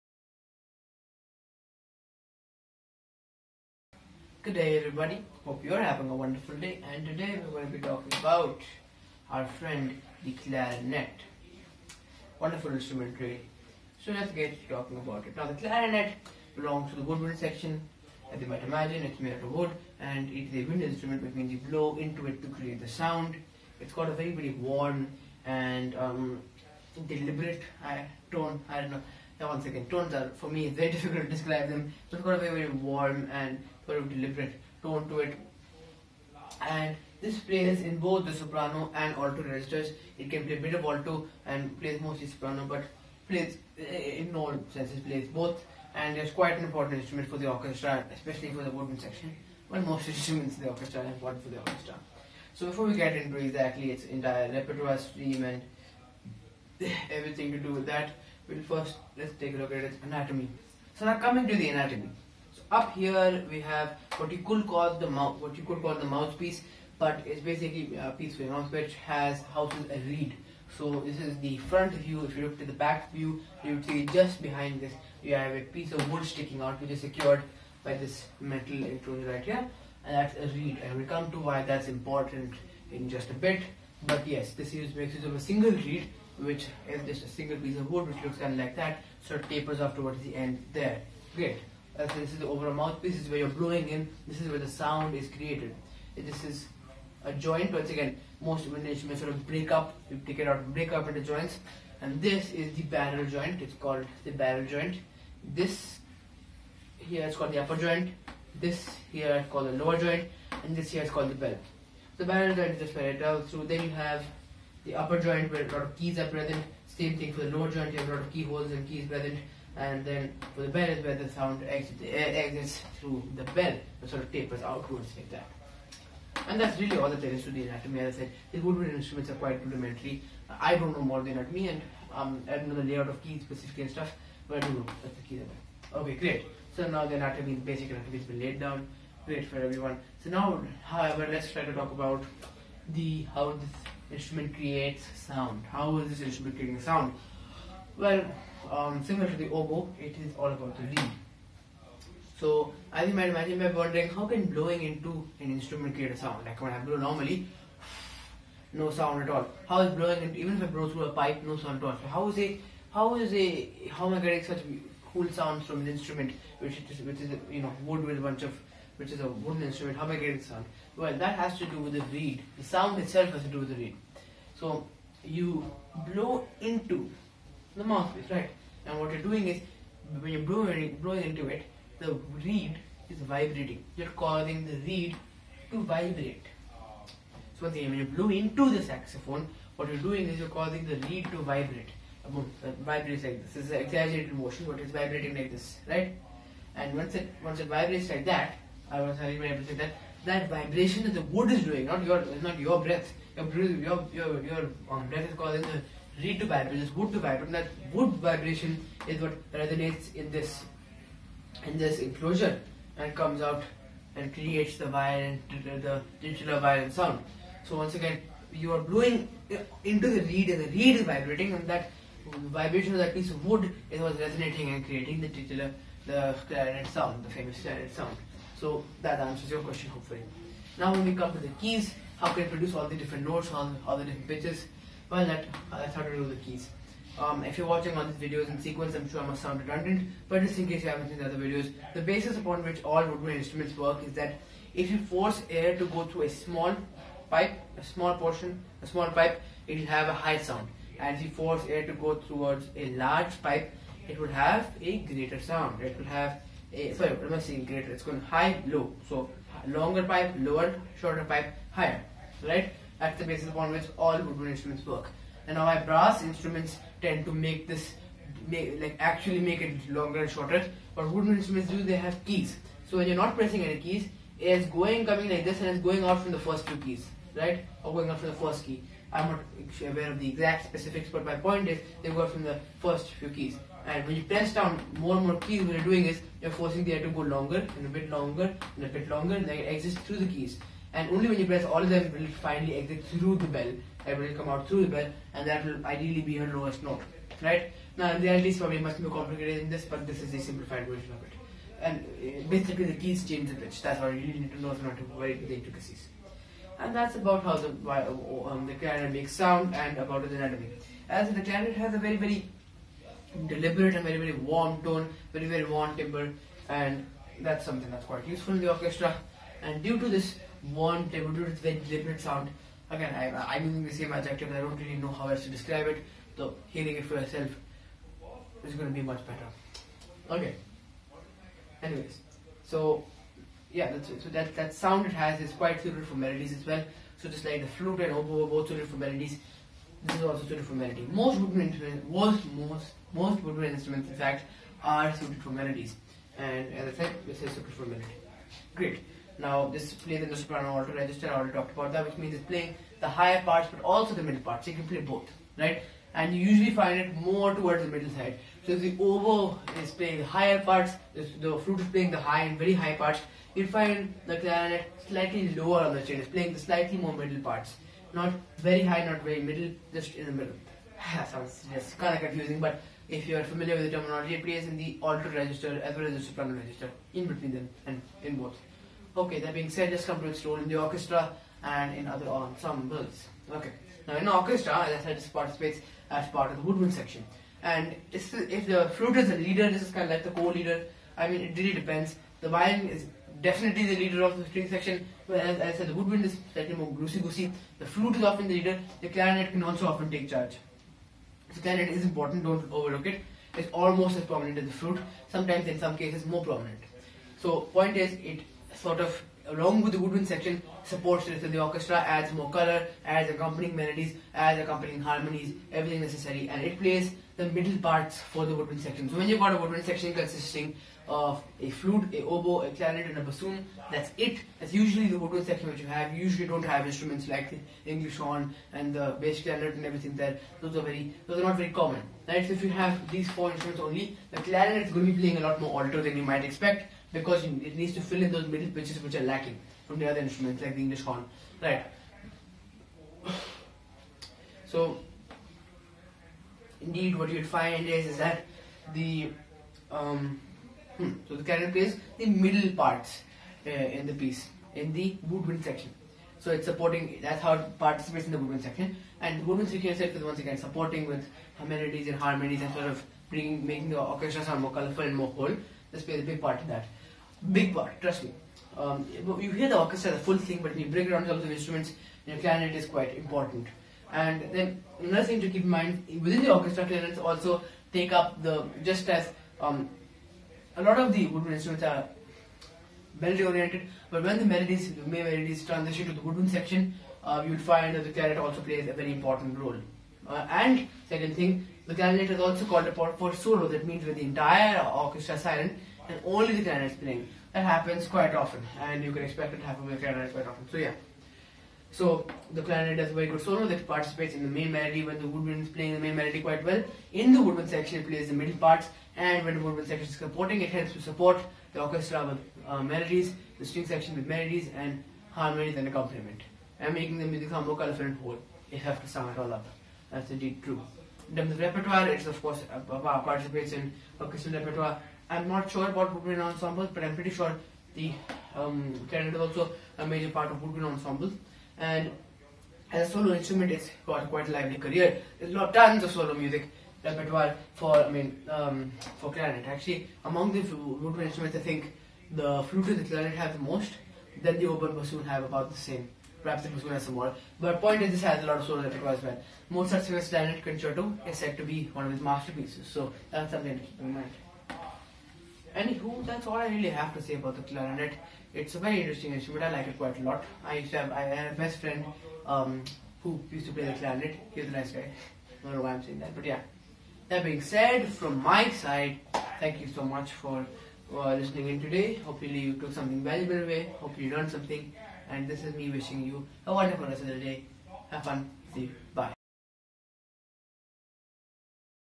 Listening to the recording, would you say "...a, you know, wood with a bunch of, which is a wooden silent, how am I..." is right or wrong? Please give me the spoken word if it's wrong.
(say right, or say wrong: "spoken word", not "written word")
wrong: "instrument", not "silent".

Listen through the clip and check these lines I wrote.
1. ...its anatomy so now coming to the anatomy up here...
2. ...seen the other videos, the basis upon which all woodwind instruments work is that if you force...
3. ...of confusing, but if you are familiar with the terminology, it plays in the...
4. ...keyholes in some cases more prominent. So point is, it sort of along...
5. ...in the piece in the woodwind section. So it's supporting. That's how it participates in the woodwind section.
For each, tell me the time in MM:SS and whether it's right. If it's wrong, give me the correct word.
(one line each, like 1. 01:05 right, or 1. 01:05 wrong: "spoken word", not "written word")
1. 00:59 right
2. 04:01 right
3. 06:12 right
4. 06:45 wrong: "sometimes", not "keyholes"
5. 07:33 right.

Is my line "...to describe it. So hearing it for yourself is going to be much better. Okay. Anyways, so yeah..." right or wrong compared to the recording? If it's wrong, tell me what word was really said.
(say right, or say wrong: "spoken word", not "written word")
right.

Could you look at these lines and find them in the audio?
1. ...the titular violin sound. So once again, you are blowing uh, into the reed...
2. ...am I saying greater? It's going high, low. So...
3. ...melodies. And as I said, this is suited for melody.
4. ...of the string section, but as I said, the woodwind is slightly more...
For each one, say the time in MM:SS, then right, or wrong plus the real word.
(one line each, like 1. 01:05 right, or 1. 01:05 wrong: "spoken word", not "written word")
1. 03:35 right
2. 04:17 right
3. 05:45 right
4. 06:34 right.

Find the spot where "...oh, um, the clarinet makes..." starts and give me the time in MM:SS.
05:08.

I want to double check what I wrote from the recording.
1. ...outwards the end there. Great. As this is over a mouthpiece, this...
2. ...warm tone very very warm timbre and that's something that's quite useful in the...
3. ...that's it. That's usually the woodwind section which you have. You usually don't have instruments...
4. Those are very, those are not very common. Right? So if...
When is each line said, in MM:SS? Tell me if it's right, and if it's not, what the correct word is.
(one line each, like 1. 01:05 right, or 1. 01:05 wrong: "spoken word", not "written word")
1. 01:29 wrong: "towards", not "outwards"
2. 05:14 right
3. 07:03 right
4. 07:10 right.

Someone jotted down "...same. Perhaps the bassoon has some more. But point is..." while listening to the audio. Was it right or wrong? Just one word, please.
right.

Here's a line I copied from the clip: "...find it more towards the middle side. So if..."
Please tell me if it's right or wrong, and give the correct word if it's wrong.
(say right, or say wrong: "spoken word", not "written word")
right.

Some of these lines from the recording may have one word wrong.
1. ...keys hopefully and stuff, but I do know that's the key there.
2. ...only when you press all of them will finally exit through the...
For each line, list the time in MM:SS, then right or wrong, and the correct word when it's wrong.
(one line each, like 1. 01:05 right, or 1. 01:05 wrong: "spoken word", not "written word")
1. 02:13 wrong: "specifically", not "hopefully"
2. 04:51 right.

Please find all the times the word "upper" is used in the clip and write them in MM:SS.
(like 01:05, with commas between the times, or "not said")
01:47, 01:54.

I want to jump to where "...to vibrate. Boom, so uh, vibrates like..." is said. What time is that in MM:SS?
03:11.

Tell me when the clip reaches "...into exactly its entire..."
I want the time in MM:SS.
00:53.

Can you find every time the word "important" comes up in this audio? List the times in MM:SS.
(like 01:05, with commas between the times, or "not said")
00:46, 00:51, 01:21, 06:42, 07:53, 08:09.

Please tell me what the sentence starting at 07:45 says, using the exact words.
This plays a big part in that big part, trust me.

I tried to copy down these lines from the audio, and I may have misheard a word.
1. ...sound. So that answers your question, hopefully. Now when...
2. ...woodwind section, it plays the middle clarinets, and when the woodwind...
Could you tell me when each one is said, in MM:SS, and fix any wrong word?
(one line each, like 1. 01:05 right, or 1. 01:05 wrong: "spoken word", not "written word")
1. 03:47 right
2. 08:27 wrong: "parts", not "clarinets".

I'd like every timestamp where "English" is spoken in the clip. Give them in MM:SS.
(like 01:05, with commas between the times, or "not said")
07:07, 07:20.